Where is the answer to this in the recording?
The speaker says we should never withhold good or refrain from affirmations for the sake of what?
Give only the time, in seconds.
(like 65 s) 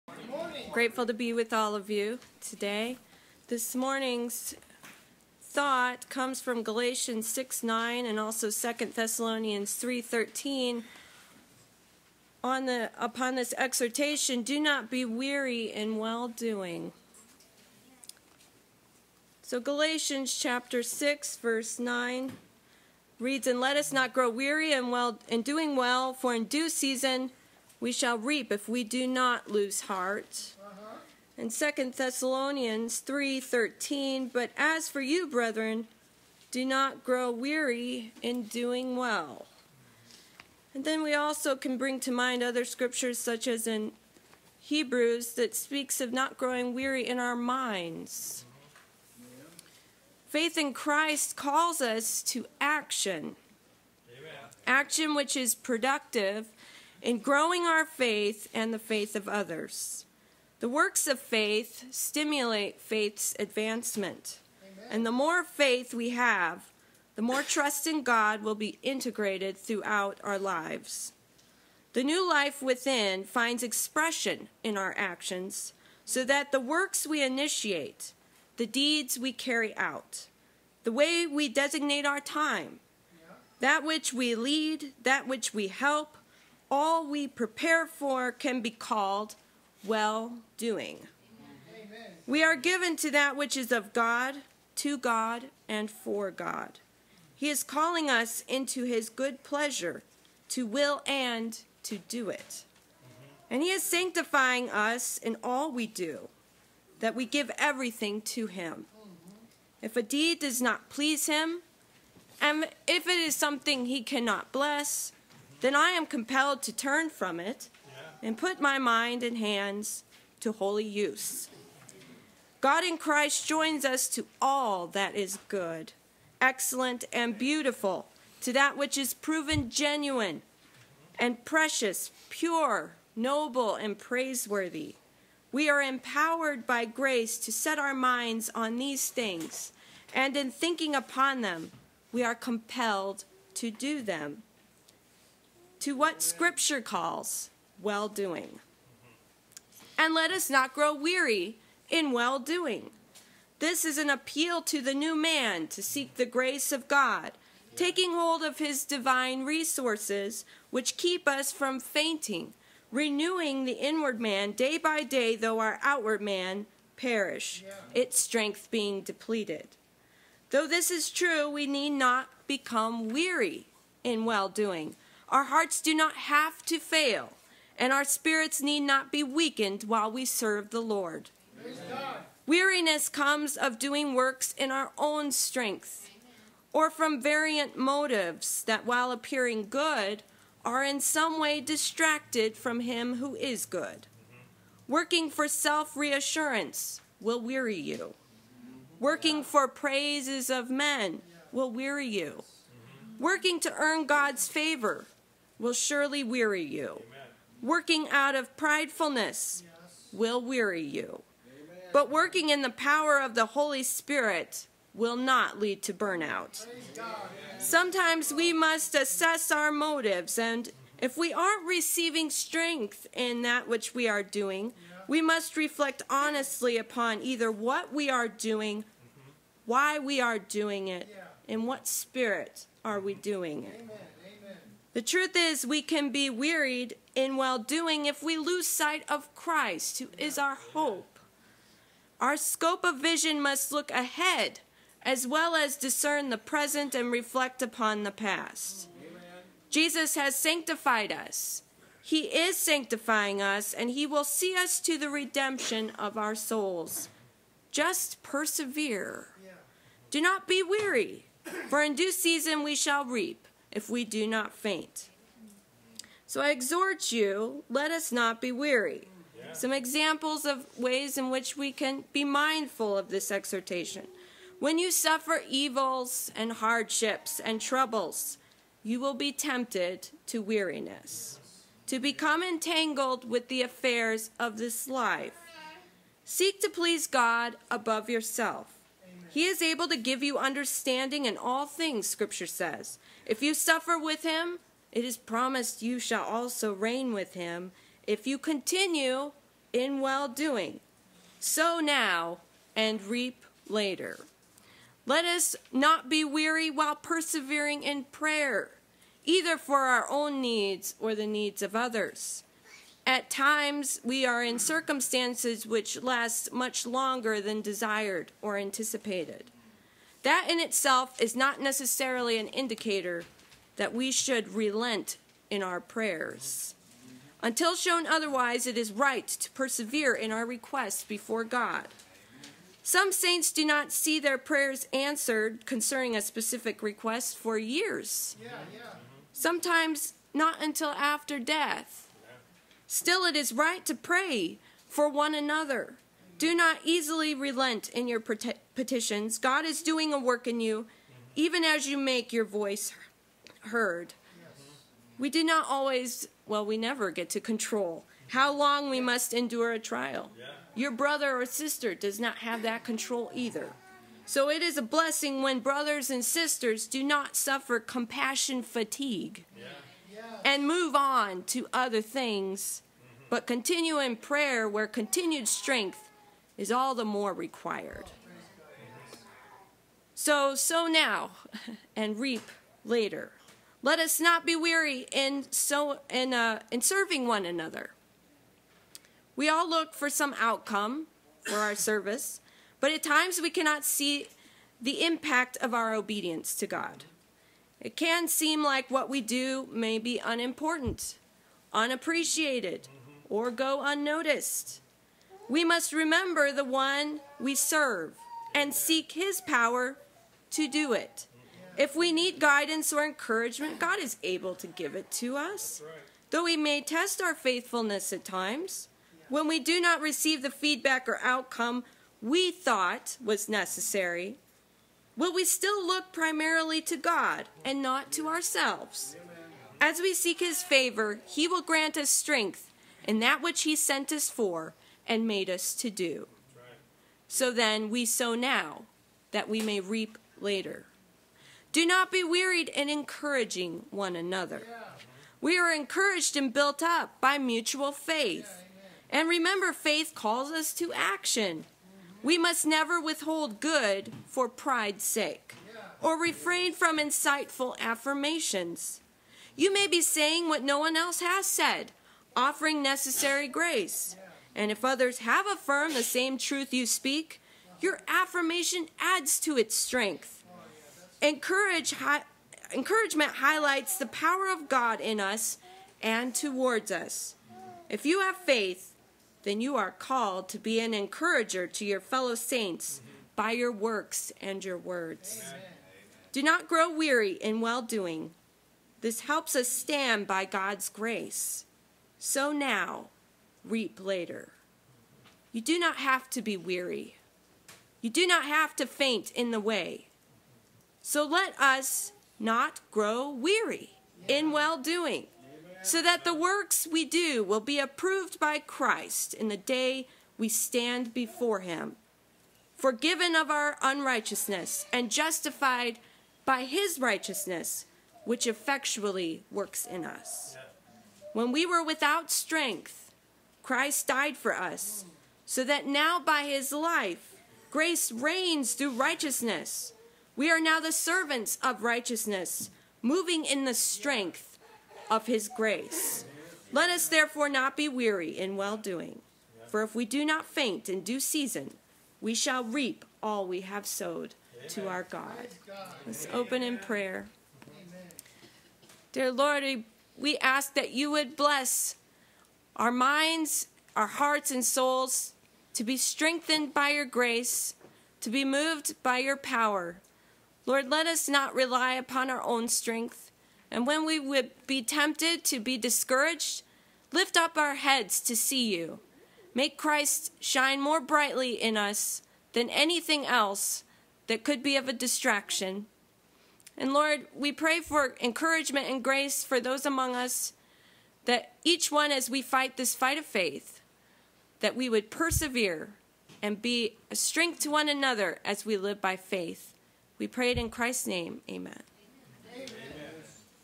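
454 s.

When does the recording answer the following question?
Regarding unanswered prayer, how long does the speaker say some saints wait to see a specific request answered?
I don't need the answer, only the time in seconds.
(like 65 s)
337 s.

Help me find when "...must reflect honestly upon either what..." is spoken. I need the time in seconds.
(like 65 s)
225 s.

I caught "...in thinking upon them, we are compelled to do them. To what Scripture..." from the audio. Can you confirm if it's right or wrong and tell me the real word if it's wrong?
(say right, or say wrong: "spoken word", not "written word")
right.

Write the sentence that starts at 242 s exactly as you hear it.
Our scope of vision must look ahead as well as discern the present and reflect upon the past.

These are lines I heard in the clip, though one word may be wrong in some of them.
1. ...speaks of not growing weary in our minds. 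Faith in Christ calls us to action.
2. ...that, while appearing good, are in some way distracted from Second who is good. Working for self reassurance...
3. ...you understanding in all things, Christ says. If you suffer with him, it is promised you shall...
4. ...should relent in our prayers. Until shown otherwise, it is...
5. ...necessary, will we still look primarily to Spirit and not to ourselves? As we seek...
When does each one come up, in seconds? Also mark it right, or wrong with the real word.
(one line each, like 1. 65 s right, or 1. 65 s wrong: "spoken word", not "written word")
1. 45 s right
2. 188 s wrong: "Him", not "Second"
3. 290 s wrong: "Scripture", not "Christ"
4. 324 s right
5. 423 s wrong: "God", not "Spirit".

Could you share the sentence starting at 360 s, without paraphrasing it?
Your brother or sister does not have that control either.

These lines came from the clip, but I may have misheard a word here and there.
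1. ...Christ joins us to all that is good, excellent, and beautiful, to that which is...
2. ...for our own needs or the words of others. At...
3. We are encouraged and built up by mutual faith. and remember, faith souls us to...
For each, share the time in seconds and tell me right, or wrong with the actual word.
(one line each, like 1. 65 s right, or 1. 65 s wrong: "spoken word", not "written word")
1. 122 s right
2. 309 s wrong: "needs", not "words"
3. 445 s wrong: "calls", not "souls".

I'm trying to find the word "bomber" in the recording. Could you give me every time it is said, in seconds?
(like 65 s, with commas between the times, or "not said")
not said.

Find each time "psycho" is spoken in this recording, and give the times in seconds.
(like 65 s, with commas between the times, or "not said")
not said.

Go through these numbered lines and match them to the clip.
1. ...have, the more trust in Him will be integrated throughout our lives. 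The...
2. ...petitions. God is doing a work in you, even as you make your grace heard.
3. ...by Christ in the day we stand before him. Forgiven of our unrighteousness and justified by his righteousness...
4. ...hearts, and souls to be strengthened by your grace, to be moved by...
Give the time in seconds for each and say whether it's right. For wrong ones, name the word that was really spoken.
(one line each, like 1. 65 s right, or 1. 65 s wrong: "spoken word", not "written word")
1. 66 s wrong: "God", not "Him"
2. 348 s wrong: "voice", not "grace"
3. 508 s right
4. 554 s right.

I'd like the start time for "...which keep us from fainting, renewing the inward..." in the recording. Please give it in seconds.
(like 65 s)
160 s.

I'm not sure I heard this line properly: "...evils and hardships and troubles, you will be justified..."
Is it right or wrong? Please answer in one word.
wrong.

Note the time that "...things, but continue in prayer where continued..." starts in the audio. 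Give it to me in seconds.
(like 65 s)
372 s.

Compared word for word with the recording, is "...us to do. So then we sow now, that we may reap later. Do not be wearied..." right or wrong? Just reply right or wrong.
right.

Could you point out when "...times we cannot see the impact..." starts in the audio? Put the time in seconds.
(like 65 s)
393 s.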